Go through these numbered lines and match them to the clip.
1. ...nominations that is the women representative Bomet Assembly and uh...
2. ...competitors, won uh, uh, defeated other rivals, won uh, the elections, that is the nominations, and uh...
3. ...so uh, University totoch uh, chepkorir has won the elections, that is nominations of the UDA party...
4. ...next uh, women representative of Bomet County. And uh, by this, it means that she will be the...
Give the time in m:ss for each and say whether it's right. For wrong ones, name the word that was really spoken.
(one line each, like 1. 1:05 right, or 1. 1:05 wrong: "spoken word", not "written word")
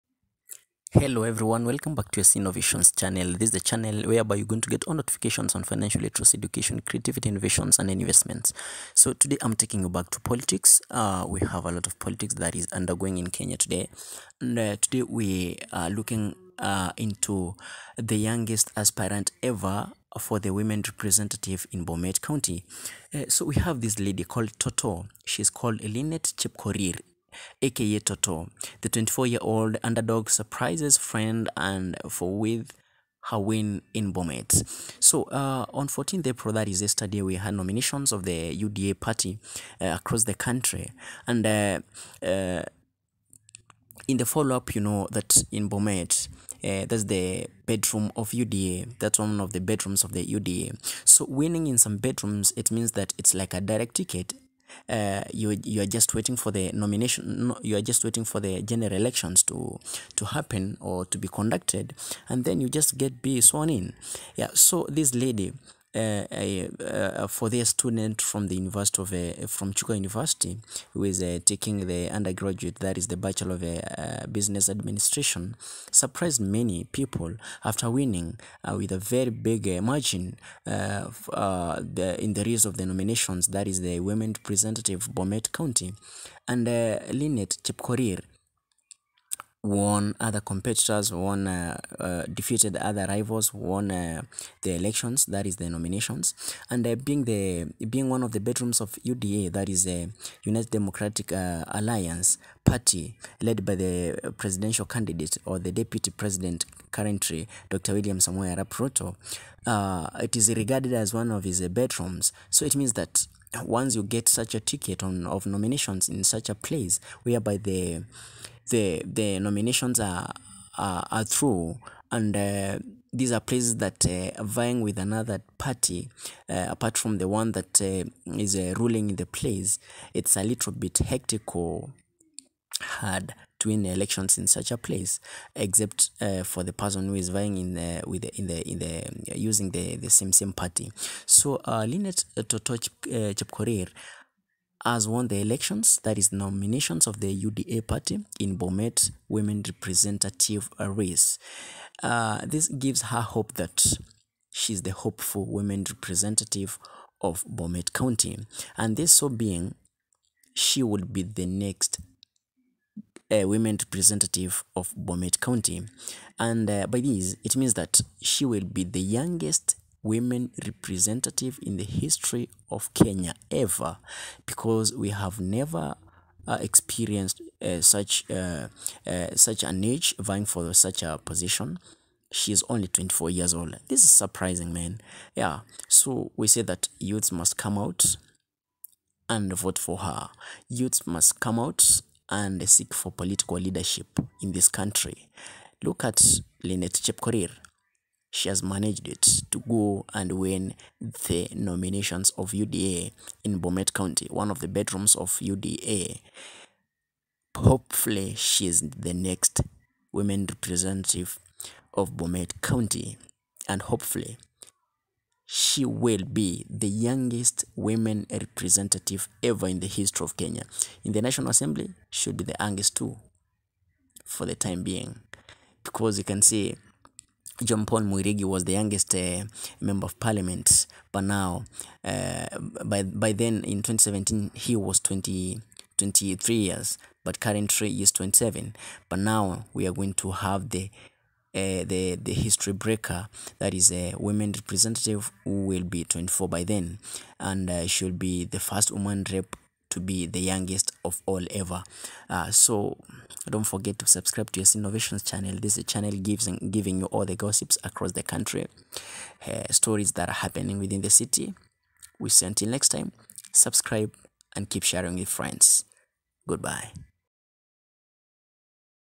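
1. 1:22 wrong: "County", not "Assembly"
2. 1:30 right
3. 2:21 wrong: "Lynette", not "University"
4. 2:41 right.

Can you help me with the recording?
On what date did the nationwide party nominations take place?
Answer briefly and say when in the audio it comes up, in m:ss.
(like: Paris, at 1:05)
14th April, at 0:35.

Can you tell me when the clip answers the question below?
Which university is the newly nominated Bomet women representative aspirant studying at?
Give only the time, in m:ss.
1:09.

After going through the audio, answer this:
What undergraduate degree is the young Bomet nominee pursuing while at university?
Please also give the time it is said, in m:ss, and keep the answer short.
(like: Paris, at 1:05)
Bachelor of Business Administration, at 1:13.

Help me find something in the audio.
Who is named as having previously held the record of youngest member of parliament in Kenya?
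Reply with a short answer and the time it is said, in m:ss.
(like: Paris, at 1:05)
John Paul Mwirigi, at 3:47.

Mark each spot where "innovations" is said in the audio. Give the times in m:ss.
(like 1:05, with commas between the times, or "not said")
0:02, 0:07, 4:14.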